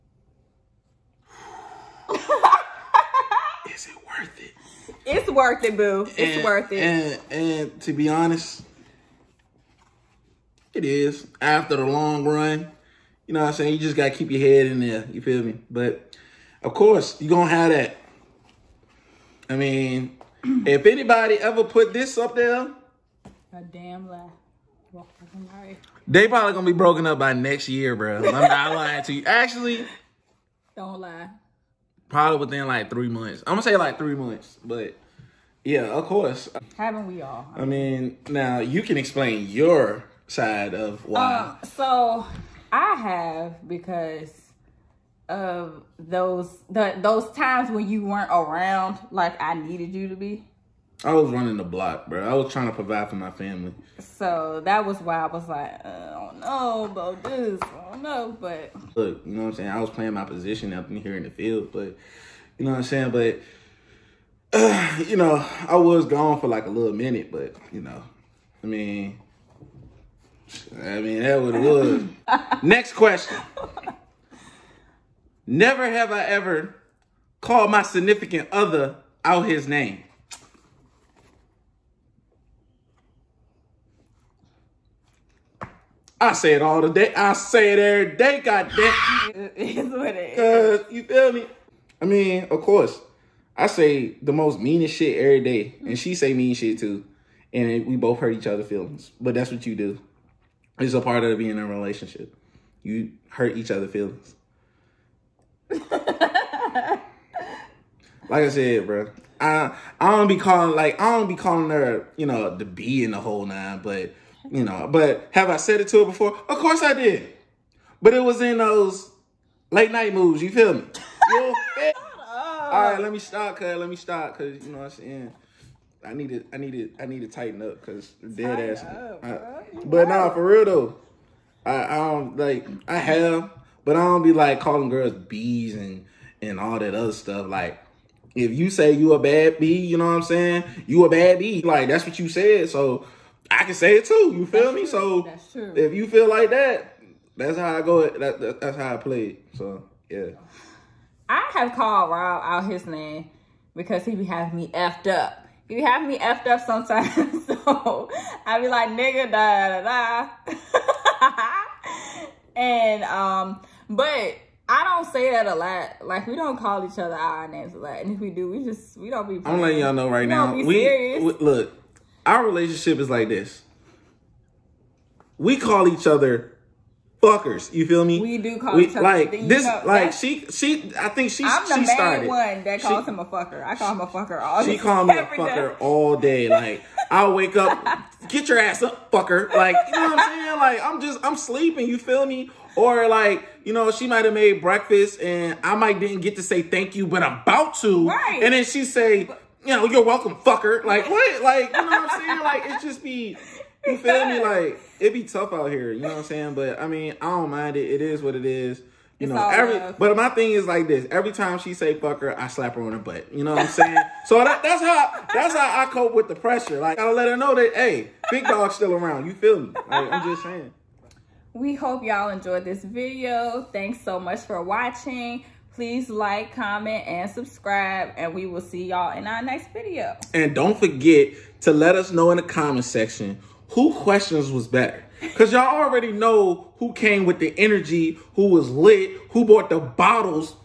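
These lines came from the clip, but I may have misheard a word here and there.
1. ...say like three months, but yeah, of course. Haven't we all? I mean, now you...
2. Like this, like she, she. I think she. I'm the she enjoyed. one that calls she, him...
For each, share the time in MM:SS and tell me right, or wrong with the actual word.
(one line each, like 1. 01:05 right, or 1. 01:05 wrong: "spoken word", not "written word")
1. 00:33 right
2. 02:59 wrong: "started", not "enjoyed".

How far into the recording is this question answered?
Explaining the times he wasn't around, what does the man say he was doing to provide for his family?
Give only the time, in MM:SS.
00:51.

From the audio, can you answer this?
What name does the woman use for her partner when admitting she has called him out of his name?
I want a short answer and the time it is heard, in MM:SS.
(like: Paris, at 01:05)
Rob, at 02:32.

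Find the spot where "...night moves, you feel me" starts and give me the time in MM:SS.
01:59.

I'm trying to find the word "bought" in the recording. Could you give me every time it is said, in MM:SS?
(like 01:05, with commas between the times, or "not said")
03:59.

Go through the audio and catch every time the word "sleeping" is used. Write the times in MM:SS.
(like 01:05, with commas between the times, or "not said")
03:11.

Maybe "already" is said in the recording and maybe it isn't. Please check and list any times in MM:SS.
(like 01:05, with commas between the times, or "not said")
03:55.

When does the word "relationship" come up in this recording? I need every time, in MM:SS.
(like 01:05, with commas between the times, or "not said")
01:41, 02:52.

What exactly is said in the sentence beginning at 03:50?
And don't forget to let us know in the comment section who questions was better?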